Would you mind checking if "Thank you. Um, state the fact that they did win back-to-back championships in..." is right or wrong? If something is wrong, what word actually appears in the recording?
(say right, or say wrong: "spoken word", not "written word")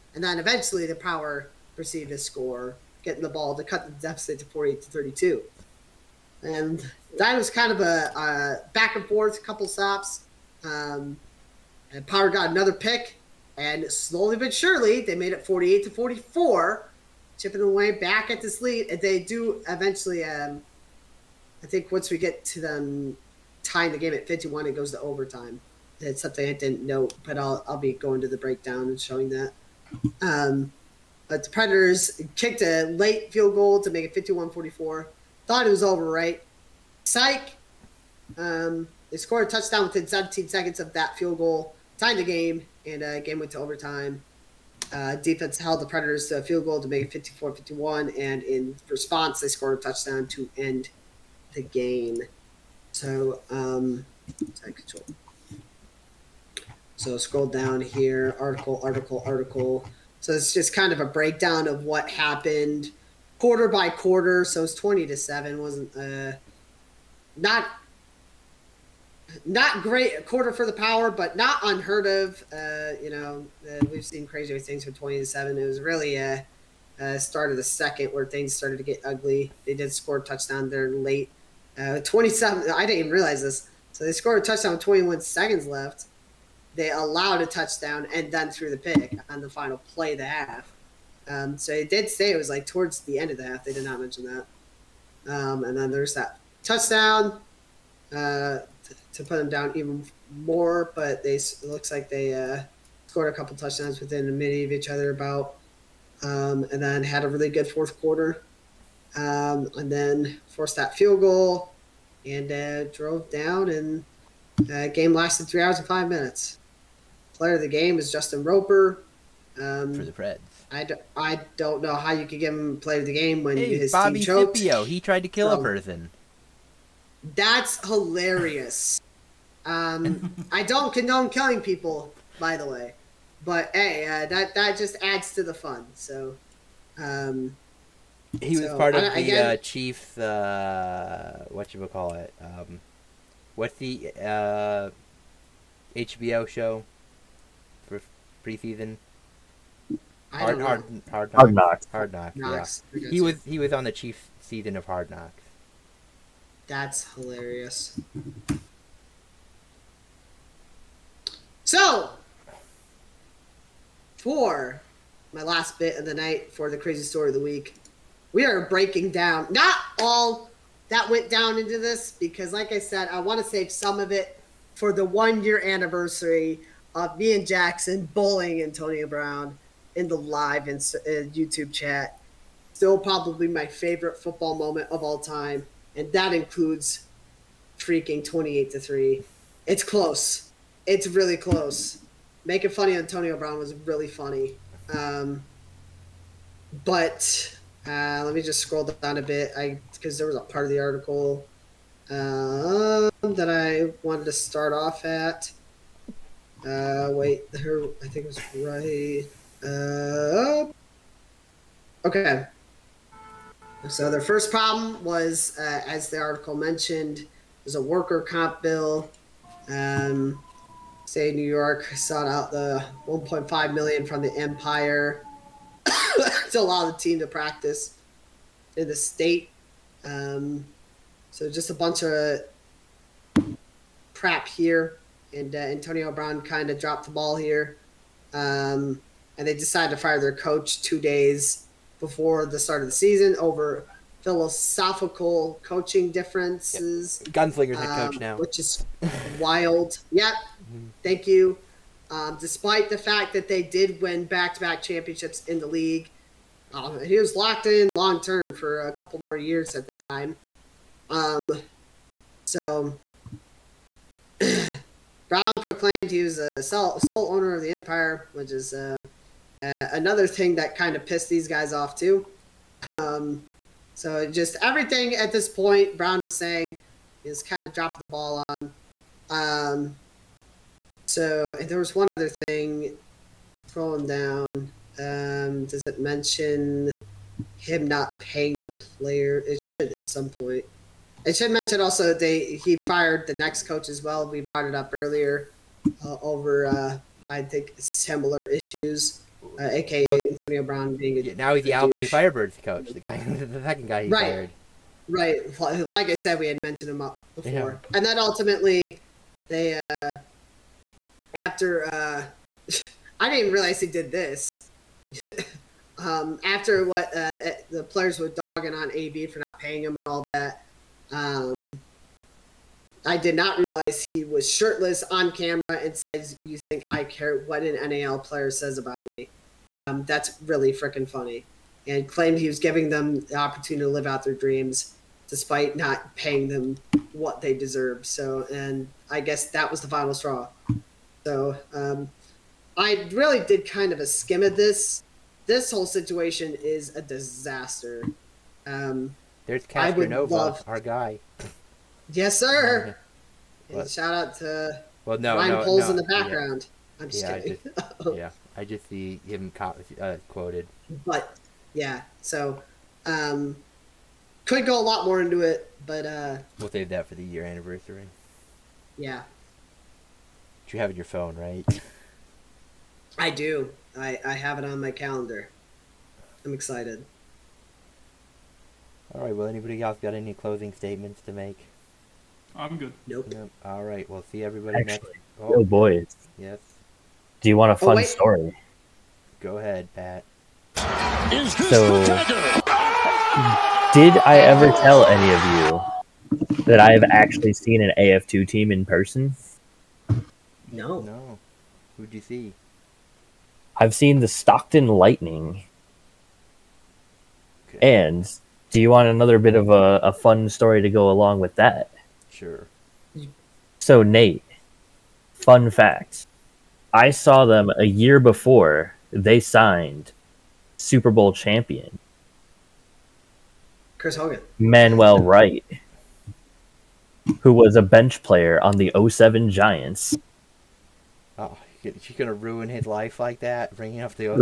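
wrong: "despite", not "state".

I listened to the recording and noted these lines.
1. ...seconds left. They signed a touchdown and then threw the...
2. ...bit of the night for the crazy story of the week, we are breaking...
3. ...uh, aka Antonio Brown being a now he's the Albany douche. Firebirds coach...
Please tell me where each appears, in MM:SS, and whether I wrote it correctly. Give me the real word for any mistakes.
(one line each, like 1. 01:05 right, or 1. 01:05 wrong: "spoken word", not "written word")
1. 01:25 wrong: "allowed", not "signed"
2. 02:45 right
3. 04:59 right.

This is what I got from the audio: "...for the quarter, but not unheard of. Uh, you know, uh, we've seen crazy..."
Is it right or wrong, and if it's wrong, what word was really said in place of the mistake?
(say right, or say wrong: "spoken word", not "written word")
wrong: "power", not "quarter".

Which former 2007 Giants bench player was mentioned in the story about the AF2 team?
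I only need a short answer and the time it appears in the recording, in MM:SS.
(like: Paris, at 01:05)
Manuel Wright, at 07:04.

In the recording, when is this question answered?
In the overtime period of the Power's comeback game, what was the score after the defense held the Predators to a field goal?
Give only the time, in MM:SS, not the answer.
00:47.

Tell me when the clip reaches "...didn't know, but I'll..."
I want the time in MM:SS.
00:26.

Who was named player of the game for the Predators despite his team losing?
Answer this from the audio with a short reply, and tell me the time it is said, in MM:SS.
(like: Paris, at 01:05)
Justin Roper, at 01:58.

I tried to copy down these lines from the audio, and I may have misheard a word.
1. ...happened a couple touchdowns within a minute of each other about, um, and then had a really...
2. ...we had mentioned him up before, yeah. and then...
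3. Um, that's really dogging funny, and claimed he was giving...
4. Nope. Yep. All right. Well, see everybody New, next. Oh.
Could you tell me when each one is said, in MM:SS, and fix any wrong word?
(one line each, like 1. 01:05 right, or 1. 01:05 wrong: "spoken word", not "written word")
1. 01:43 wrong: "scored", not "happened"
2. 05:06 right
3. 05:29 wrong: "freaking", not "dogging"
4. 06:23 wrong: "Actually", not "New".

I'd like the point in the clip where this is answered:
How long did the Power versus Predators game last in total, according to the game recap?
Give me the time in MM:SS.
01:55.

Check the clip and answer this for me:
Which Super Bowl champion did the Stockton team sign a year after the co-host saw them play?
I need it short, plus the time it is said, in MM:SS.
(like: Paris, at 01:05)
Chris Hogan, at 07:03.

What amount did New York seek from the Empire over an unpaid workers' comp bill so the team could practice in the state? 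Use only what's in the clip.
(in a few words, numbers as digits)
1.5 million.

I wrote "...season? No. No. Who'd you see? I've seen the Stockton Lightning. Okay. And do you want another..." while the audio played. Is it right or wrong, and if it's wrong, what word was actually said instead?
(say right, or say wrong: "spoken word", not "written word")
wrong: "person", not "season".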